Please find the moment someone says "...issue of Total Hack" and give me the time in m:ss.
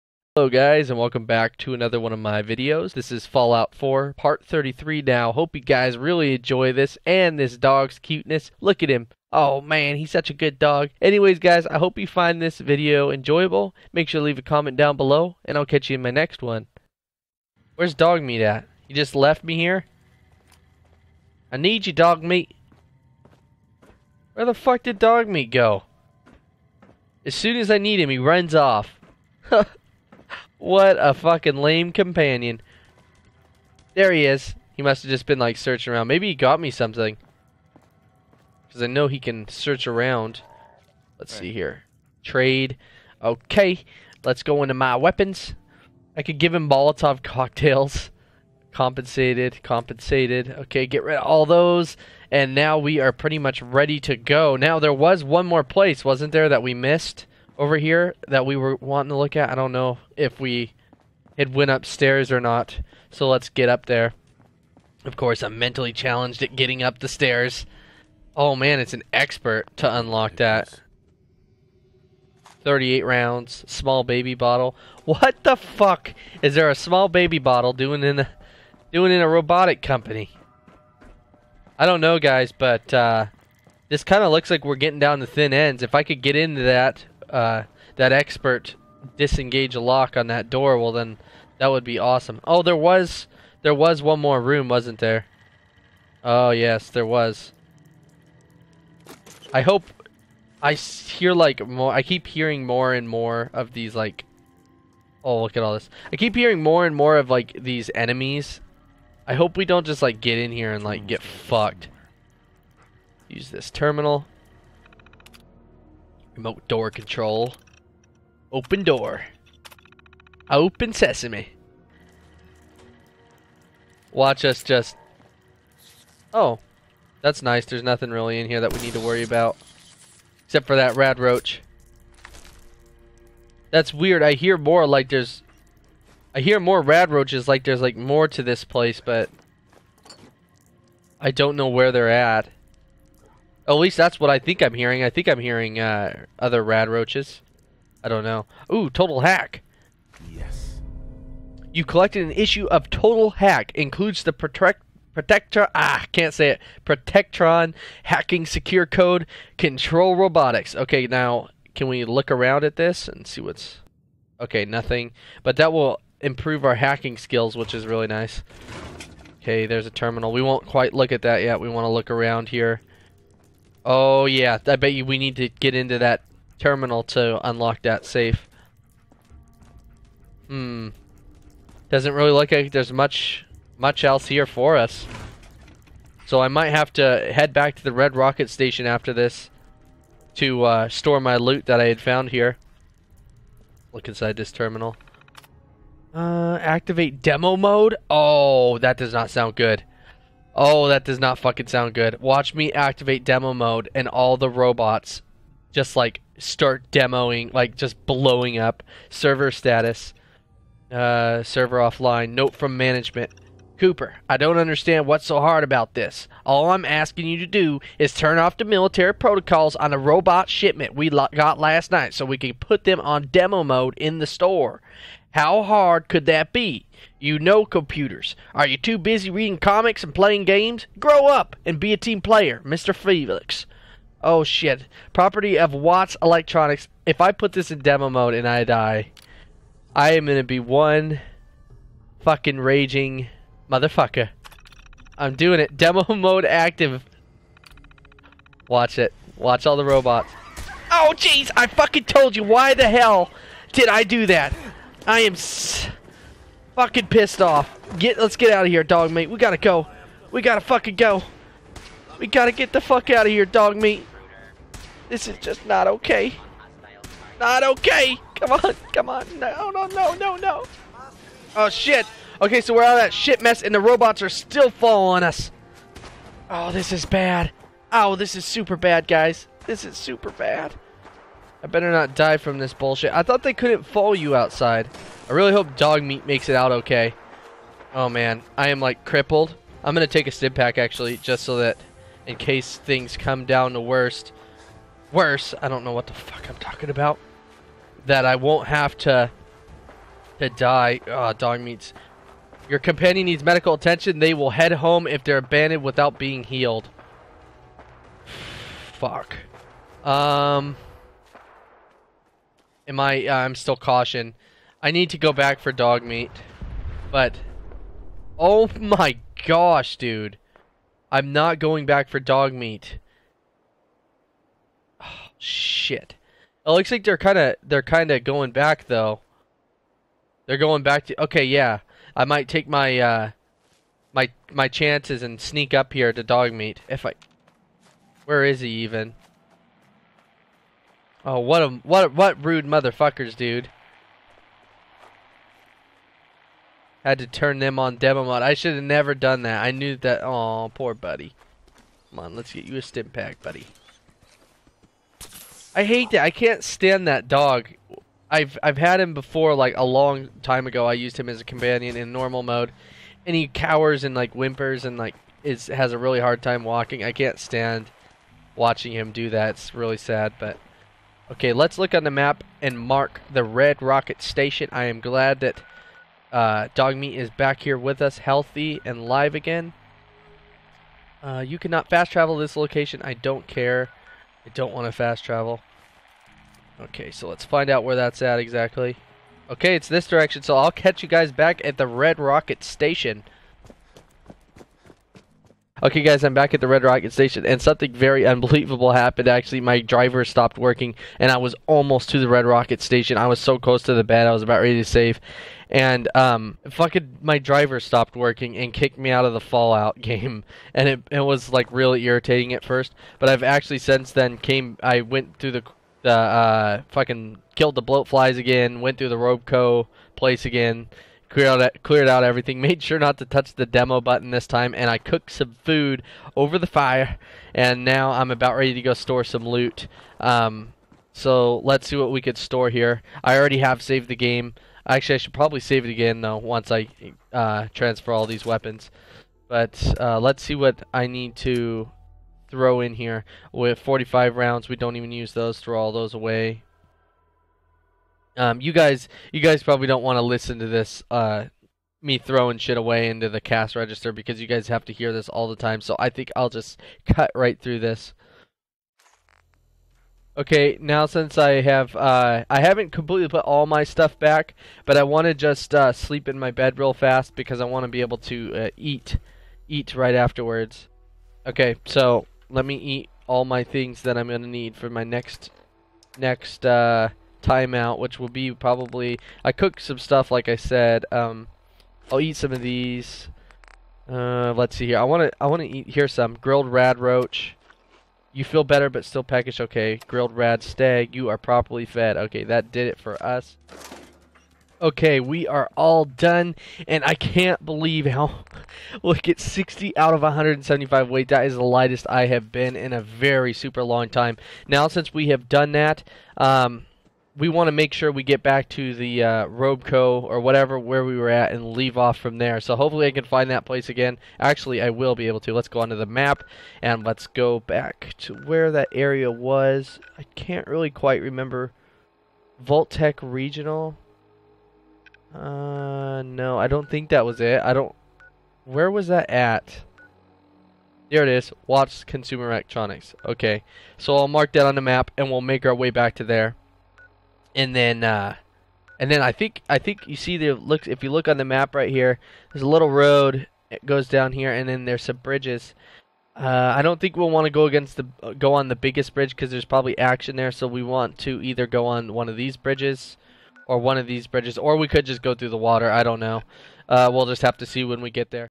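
2:32.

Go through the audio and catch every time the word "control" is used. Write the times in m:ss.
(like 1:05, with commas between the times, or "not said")
1:56, 2:39.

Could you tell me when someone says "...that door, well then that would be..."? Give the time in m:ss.
1:30.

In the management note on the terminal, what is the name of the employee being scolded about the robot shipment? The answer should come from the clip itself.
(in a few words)
Cooper.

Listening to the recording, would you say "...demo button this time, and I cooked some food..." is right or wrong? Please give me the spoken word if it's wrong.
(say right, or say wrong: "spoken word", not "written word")
right.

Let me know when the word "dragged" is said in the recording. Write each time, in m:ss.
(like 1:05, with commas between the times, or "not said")
not said.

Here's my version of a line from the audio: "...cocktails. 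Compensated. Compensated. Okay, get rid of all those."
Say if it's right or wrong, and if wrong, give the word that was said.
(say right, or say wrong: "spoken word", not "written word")
right.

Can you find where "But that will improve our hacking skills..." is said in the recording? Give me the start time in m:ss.
2:45.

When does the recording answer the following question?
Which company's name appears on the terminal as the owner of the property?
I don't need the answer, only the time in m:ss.
3:55.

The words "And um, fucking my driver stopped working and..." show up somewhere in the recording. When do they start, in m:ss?
6:45.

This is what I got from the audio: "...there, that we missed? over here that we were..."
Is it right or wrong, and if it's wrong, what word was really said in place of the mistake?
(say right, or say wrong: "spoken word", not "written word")
right.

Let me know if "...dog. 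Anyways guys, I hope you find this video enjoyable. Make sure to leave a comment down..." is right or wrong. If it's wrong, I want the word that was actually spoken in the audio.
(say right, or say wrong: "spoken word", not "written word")
right.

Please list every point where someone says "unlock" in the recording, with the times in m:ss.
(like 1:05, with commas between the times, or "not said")
1:09, 2:57.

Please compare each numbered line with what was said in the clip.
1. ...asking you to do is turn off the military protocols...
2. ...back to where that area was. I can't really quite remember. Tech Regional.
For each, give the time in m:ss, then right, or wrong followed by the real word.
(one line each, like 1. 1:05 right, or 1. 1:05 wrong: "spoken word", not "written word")
1. 3:36 right
2. 8:37 right.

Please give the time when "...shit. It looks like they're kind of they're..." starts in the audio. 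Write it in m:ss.
5:25.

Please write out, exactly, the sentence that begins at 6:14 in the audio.
I am glad that uh, Dog Meat is back here with us, healthy and live again.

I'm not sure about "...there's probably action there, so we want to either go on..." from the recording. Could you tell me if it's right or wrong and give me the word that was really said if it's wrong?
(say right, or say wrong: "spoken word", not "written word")
right.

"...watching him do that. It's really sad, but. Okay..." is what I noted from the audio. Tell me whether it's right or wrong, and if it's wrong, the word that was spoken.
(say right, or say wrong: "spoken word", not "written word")
right.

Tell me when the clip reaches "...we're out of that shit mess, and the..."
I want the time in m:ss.
4:32.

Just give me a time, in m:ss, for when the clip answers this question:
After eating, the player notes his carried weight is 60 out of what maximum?
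8:20.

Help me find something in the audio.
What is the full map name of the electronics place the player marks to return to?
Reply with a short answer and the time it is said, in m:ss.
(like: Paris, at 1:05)
Wattz Consumer Electronics, at 8:51.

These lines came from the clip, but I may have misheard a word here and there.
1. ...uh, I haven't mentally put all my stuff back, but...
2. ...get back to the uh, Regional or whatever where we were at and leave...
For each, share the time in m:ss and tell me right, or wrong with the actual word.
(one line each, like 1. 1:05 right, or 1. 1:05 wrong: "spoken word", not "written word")
1. 7:41 wrong: "completely", not "mentally"
2. 8:28 wrong: "Robeco", not "Regional".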